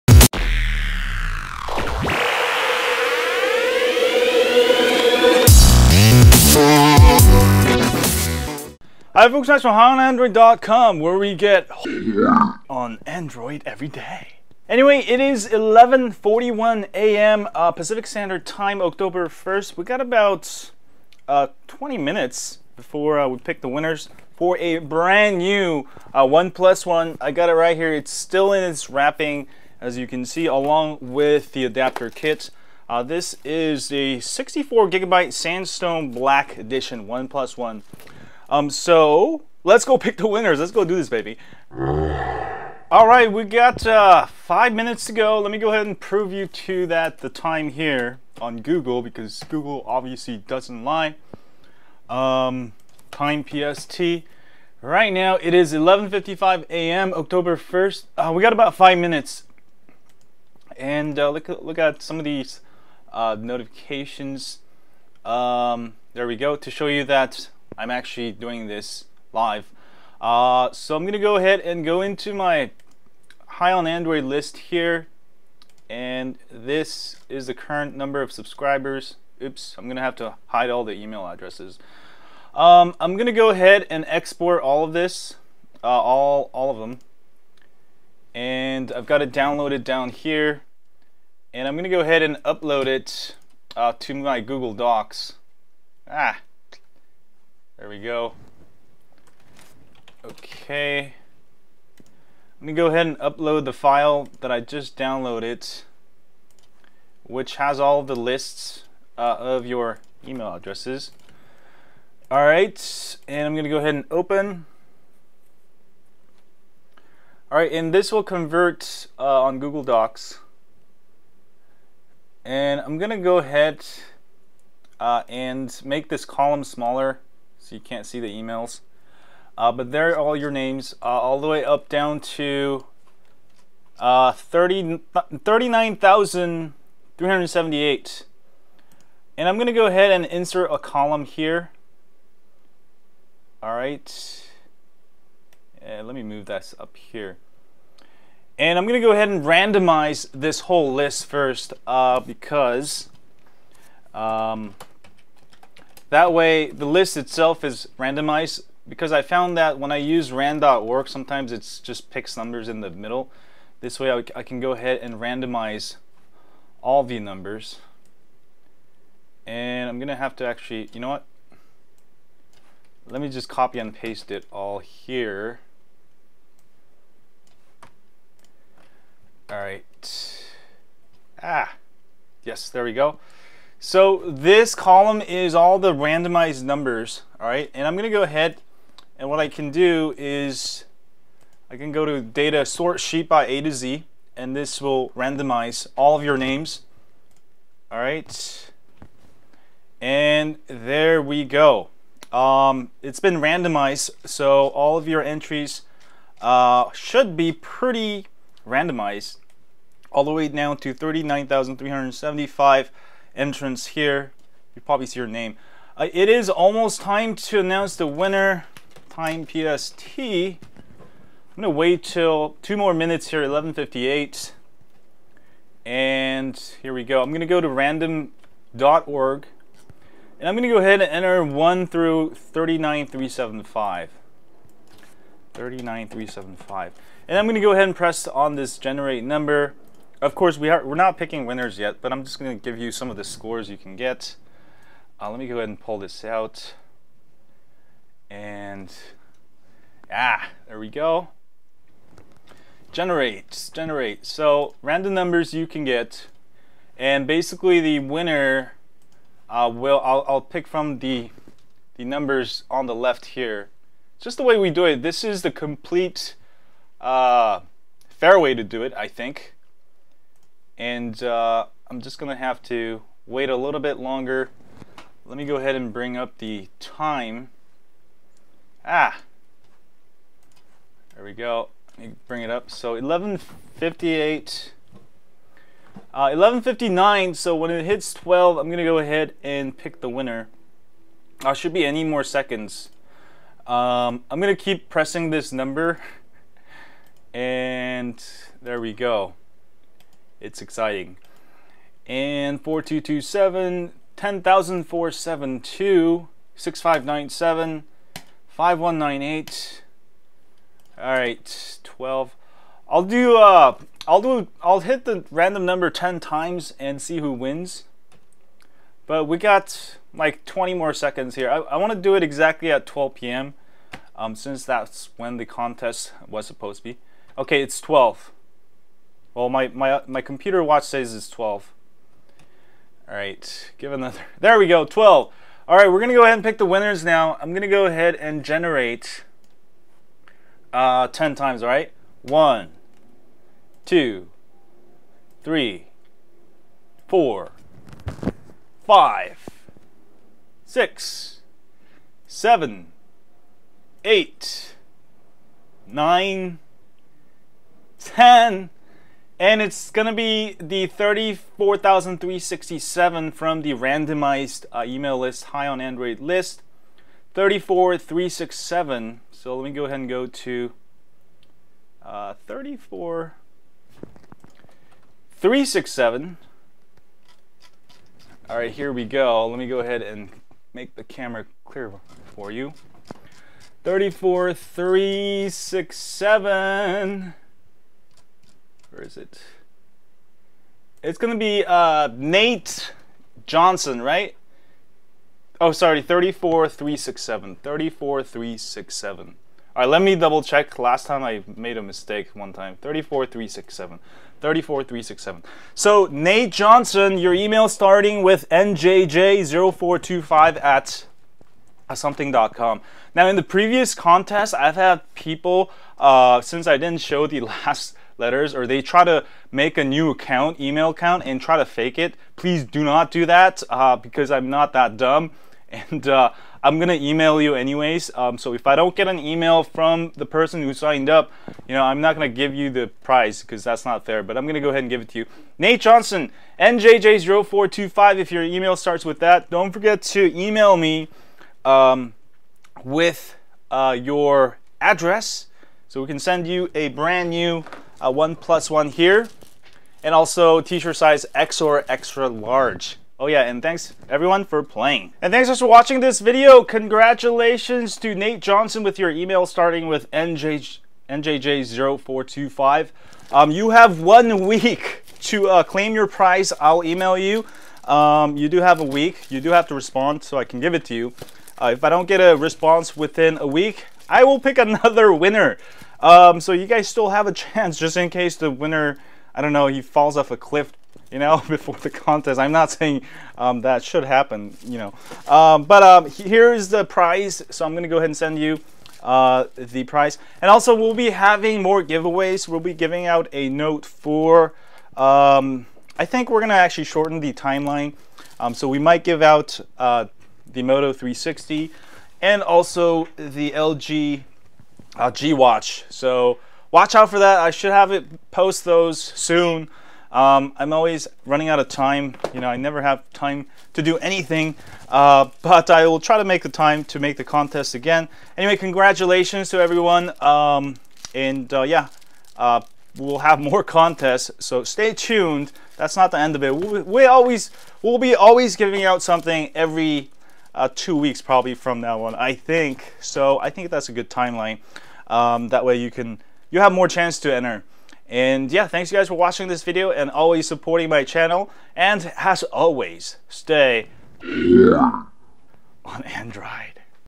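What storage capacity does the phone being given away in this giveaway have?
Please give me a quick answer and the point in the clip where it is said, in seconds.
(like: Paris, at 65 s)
64 gigabytes, at 34 s.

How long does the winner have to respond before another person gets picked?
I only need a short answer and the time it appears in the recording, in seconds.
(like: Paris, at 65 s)
one week, at 464 s.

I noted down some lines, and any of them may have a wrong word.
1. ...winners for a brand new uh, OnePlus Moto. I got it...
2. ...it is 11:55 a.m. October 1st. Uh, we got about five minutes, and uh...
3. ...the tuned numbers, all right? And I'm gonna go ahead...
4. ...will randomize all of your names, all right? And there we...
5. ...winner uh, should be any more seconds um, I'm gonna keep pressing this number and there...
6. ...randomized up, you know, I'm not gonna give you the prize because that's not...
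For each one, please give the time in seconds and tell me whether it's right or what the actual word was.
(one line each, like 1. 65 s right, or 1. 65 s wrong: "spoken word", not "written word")
1. 23 s wrong: "One", not "Moto"
2. 55 s right
3. 185 s wrong: "randomized", not "tuned"
4. 194 s right
5. 290 s right
6. 430 s wrong: "signed", not "randomized".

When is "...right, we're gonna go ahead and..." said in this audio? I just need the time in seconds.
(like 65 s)
335 s.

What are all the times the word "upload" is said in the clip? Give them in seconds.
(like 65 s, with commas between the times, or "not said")
92 s, 103 s.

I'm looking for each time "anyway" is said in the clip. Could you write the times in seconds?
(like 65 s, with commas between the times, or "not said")
14 s, 427 s, 518 s.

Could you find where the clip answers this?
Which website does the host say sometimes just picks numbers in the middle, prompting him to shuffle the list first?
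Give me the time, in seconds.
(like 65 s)
160 s.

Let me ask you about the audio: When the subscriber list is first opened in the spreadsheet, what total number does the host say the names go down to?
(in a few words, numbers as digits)
39,378.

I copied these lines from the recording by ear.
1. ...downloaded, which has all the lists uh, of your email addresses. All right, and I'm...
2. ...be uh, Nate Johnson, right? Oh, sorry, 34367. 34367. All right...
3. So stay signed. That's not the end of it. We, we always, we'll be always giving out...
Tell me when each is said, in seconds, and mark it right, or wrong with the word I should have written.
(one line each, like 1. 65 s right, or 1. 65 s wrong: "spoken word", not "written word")
1. 104 s right
2. 391 s right
3. 524 s wrong: "tuned", not "signed".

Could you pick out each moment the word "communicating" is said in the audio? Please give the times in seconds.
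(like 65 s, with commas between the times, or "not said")
not said.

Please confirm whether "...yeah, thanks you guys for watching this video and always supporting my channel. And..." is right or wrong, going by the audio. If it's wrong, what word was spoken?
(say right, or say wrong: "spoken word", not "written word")
right.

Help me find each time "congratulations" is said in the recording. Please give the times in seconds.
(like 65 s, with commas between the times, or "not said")
456 s, 518 s.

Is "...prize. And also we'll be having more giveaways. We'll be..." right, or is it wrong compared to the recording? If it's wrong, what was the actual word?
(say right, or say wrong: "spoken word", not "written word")
right.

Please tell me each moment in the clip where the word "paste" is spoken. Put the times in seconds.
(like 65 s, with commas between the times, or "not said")
173 s.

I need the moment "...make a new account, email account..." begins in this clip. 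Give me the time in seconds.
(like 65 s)
419 s.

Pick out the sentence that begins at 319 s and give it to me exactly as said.
But we got like 20 more seconds here.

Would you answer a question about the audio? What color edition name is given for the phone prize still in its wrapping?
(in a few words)
Sandstone Black.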